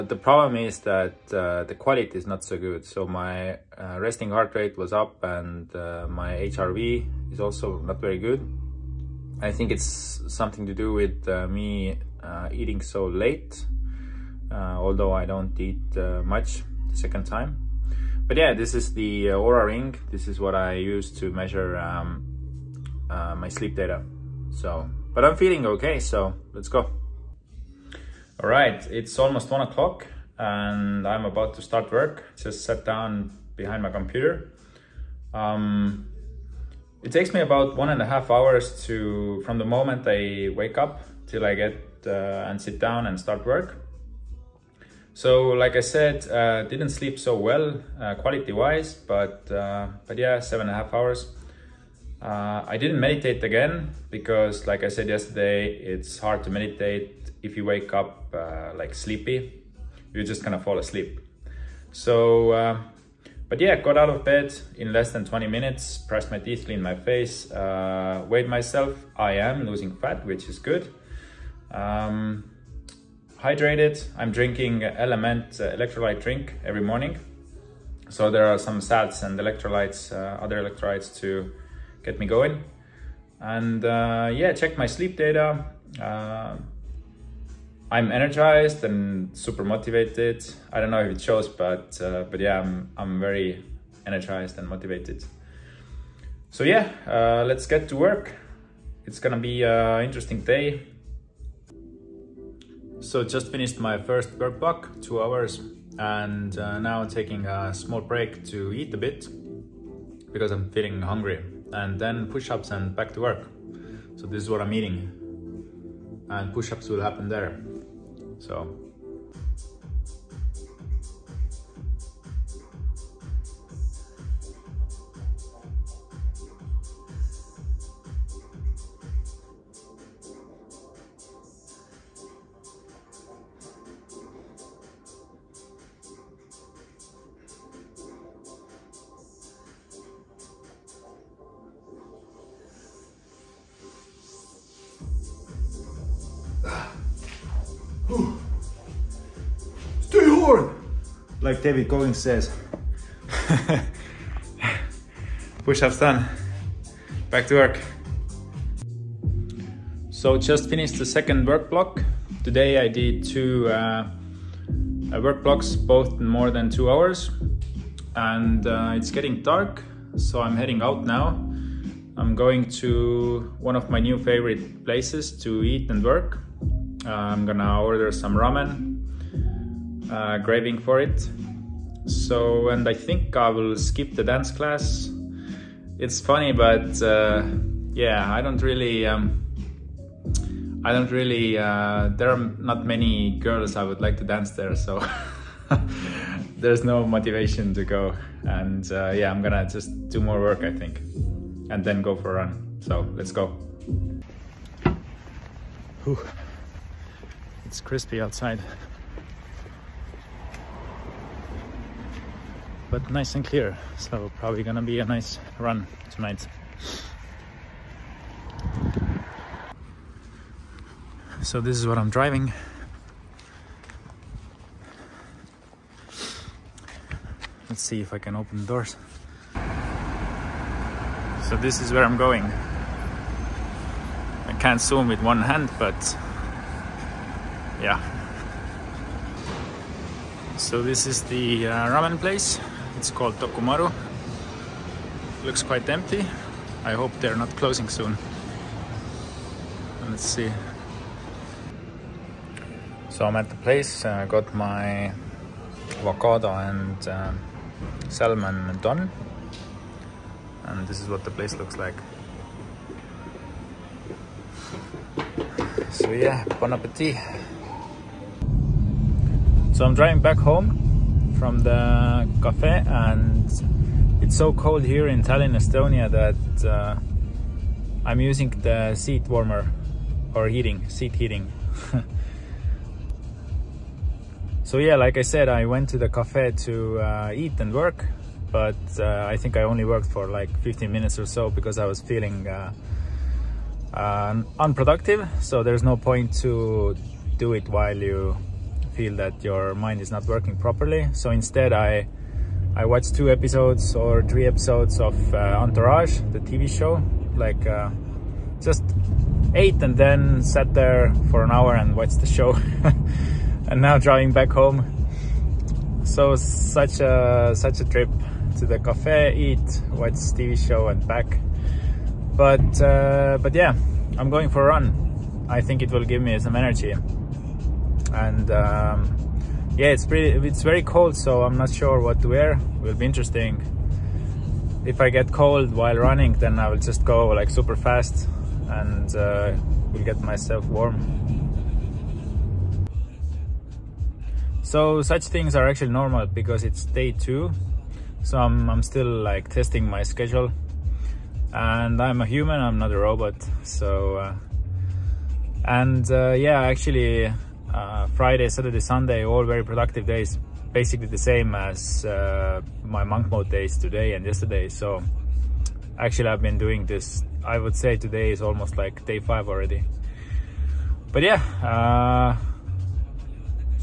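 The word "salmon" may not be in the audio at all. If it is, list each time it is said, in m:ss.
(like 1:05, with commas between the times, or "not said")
4:18.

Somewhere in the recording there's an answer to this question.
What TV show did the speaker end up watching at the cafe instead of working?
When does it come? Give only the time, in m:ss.
5:05.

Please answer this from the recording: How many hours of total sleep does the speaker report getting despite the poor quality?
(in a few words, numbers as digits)
7.5 hours.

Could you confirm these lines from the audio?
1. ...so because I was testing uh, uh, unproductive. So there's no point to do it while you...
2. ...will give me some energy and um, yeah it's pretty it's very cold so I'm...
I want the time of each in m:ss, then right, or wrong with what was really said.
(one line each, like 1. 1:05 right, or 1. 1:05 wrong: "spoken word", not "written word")
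1. 4:51 wrong: "feeling", not "testing"
2. 5:25 right.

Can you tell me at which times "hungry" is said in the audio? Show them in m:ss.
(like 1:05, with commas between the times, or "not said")
1:51.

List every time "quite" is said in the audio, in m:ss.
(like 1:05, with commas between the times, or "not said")
4:05.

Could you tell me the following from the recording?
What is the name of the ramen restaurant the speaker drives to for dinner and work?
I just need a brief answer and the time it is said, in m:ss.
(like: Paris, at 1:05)
Tokumaru, at 4:03.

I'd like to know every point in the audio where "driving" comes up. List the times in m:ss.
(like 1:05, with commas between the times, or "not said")
3:42, 4:29, 5:13.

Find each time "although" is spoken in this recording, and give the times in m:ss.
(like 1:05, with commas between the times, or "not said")
0:14.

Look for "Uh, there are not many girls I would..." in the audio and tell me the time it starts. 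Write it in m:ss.
3:11.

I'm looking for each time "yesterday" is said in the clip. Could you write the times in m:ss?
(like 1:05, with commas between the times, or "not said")
0:55, 6:04.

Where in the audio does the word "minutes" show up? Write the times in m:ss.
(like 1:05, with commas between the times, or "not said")
1:05, 4:50.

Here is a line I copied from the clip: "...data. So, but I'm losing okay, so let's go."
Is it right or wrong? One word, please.
wrong.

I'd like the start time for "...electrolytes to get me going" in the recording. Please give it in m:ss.
1:20.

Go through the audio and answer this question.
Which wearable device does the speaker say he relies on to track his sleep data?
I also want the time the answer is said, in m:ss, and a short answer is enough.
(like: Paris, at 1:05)
Oura Ring, at 0:19.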